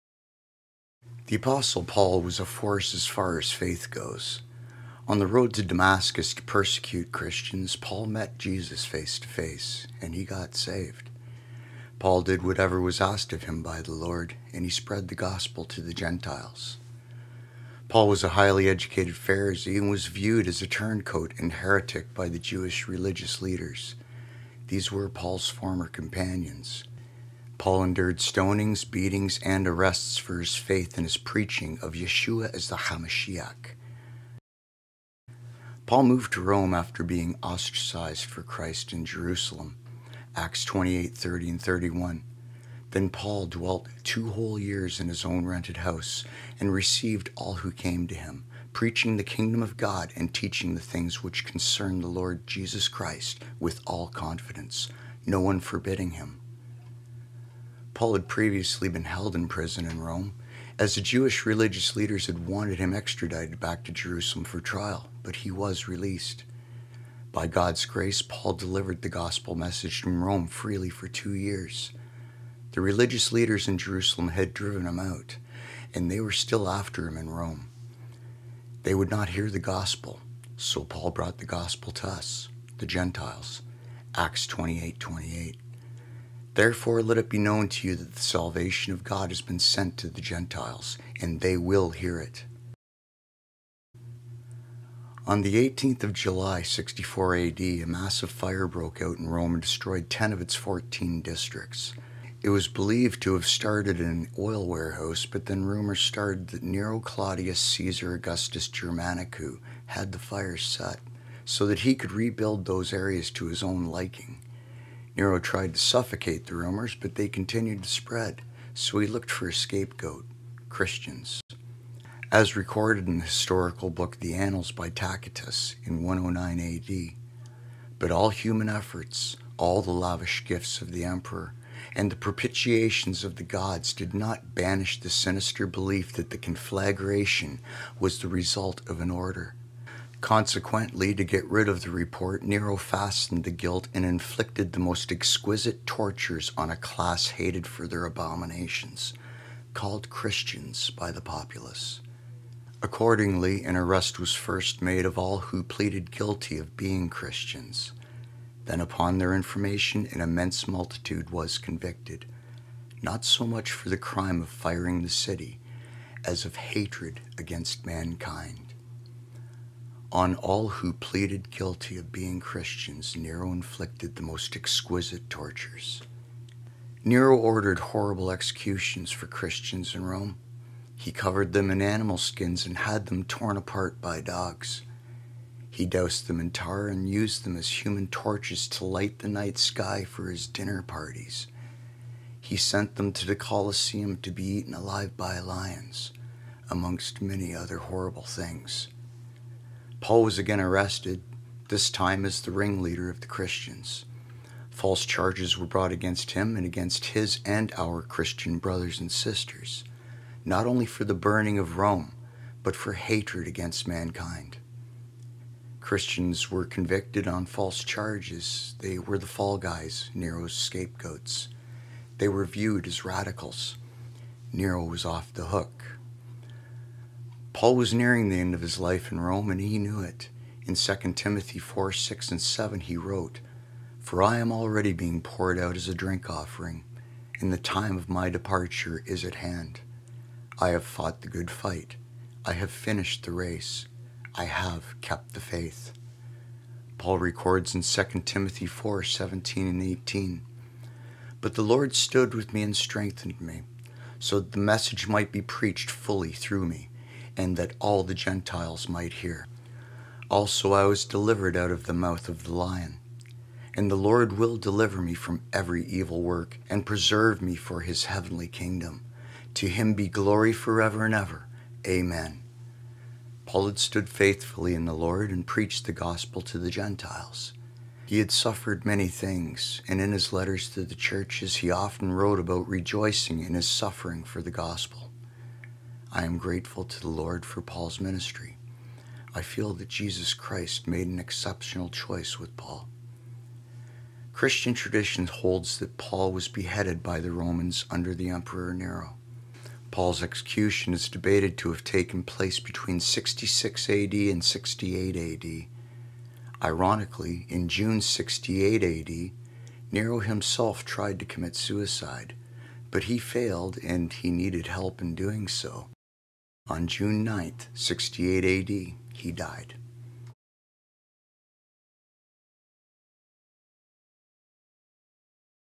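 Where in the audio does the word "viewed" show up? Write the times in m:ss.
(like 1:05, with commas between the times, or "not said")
0:20, 3:42.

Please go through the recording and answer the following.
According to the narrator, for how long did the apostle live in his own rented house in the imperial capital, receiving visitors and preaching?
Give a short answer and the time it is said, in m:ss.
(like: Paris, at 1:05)
2 years, at 0:44.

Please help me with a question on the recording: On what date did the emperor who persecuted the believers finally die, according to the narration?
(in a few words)
June 9, 68 AD.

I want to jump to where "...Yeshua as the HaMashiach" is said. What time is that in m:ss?
0:31.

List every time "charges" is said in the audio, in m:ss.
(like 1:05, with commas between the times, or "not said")
3:25, 3:37.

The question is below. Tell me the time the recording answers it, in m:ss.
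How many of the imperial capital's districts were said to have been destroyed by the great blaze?
1:40.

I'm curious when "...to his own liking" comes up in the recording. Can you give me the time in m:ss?
1:53.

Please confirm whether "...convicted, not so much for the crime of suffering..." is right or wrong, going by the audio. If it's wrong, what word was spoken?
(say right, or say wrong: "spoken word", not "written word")
wrong: "firing", not "suffering".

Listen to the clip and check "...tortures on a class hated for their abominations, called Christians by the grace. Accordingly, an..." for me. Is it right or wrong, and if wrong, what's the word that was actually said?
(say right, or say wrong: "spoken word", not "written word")
wrong: "populace", not "grace".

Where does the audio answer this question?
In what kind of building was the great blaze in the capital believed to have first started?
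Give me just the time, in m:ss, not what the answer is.
1:44.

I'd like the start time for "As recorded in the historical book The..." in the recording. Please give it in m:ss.
2:02.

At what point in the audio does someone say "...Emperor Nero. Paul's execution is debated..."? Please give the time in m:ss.
4:58.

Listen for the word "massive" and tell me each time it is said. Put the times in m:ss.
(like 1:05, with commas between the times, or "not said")
1:37.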